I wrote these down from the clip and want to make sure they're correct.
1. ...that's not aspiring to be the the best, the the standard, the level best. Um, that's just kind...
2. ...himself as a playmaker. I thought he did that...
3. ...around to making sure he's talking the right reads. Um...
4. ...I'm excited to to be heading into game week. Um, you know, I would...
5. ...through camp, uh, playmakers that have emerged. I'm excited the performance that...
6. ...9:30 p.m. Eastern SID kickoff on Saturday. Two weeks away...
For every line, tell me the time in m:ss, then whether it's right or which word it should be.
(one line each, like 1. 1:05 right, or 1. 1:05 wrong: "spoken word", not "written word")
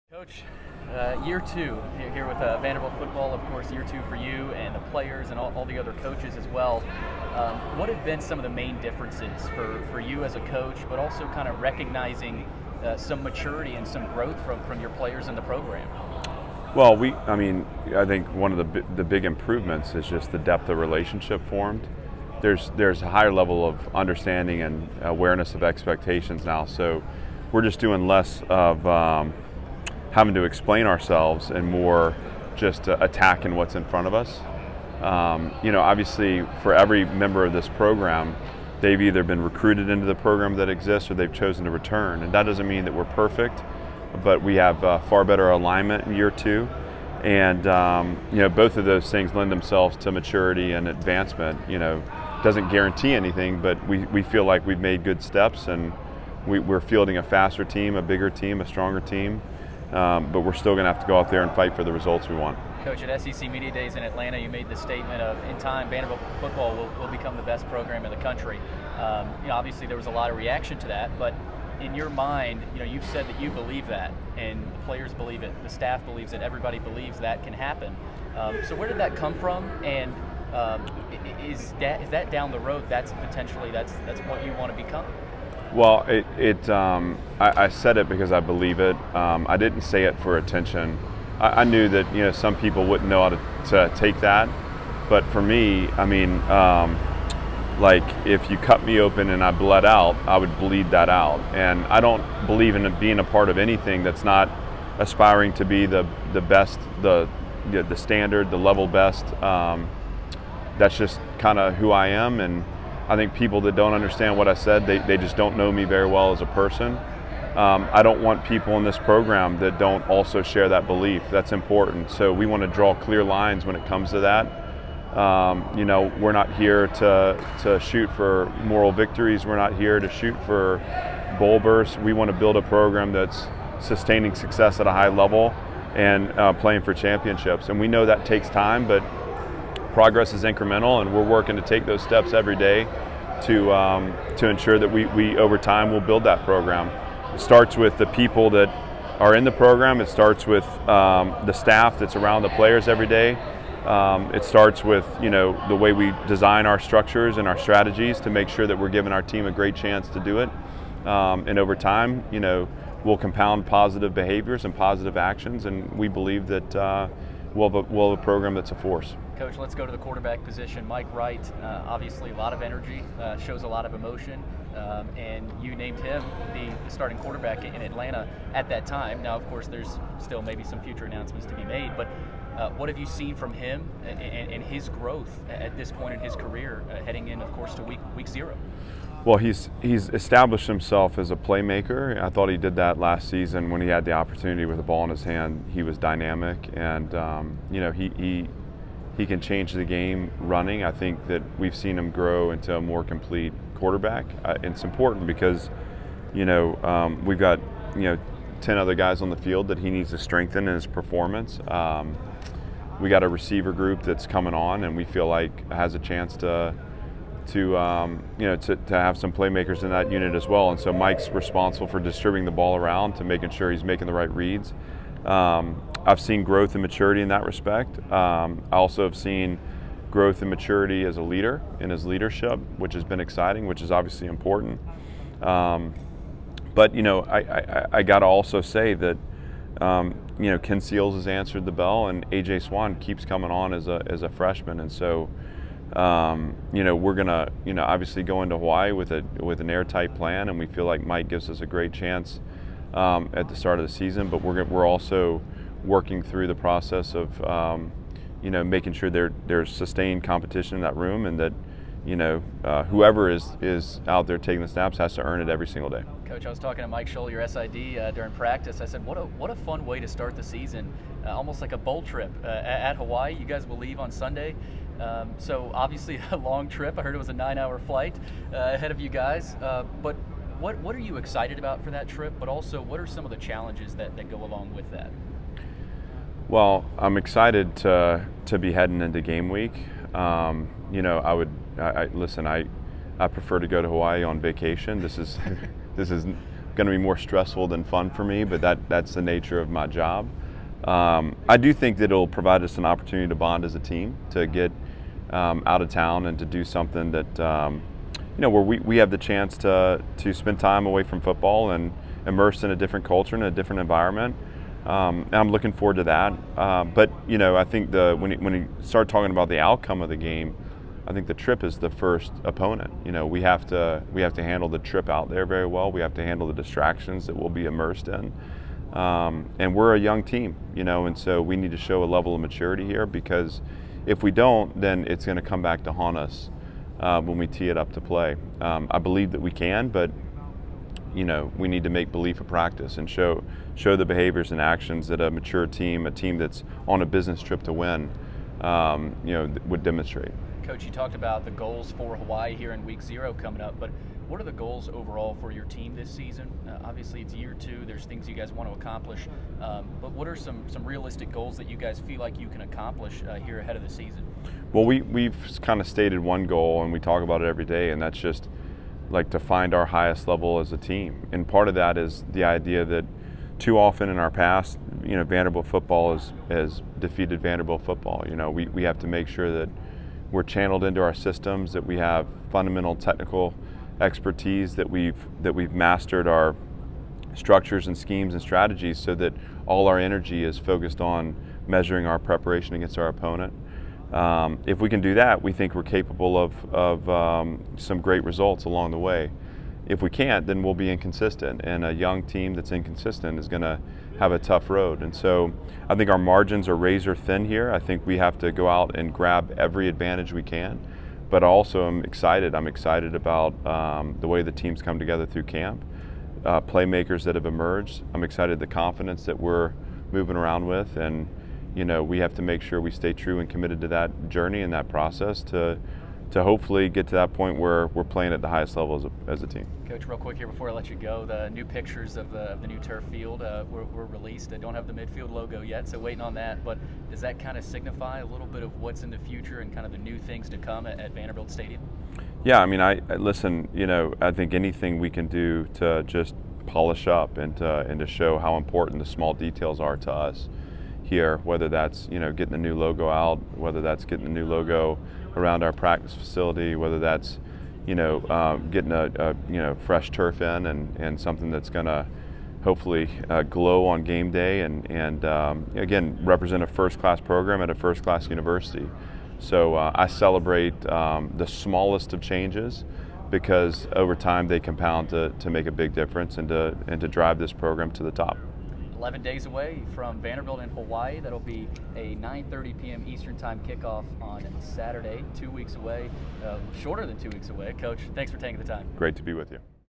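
1. 1:44 right
2. 3:10 right
3. 3:42 wrong: "making", not "talking"
4. 4:46 right
5. 6:55 wrong: "confidence", not "performance"
6. 8:02 wrong: "Time", not "SID".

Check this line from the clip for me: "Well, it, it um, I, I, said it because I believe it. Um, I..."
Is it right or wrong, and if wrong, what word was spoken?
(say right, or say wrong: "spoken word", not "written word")
right.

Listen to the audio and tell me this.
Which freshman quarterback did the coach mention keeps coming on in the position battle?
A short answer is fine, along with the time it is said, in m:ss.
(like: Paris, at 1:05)
AJ Swann, at 4:02.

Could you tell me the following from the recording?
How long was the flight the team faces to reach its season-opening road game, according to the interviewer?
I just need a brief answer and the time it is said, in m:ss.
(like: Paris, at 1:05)
9 hours, at 4:37.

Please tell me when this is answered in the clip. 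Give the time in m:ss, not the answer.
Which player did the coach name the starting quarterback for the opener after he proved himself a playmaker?
2:50.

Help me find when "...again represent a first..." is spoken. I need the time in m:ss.
7:45.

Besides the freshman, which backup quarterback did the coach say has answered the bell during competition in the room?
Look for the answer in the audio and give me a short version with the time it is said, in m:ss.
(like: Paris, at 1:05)
Ken Seals, at 4:00.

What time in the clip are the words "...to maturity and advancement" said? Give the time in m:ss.
0:49.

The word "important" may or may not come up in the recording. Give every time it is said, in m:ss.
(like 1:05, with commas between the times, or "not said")
2:01, 3:24, 3:54, 7:28.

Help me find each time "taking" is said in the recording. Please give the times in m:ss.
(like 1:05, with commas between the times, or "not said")
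4:24, 8:08.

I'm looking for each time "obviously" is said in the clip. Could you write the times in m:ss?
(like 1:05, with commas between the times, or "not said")
0:35, 1:09, 2:51, 3:53, 4:07, 4:35, 5:56.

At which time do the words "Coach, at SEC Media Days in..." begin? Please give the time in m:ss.
1:02.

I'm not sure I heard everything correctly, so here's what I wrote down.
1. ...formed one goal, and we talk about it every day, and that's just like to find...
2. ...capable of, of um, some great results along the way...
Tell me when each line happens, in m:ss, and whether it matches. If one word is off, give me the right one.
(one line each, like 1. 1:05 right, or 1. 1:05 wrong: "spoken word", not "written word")
1. 6:05 wrong: "stated", not "formed"
2. 6:35 right.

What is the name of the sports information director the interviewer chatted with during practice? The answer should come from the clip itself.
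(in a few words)
Mike Scholl.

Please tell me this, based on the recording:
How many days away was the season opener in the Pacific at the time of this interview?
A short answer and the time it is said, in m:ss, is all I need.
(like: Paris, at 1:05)
11, at 7:59.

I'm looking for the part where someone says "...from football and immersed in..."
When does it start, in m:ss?
5:11.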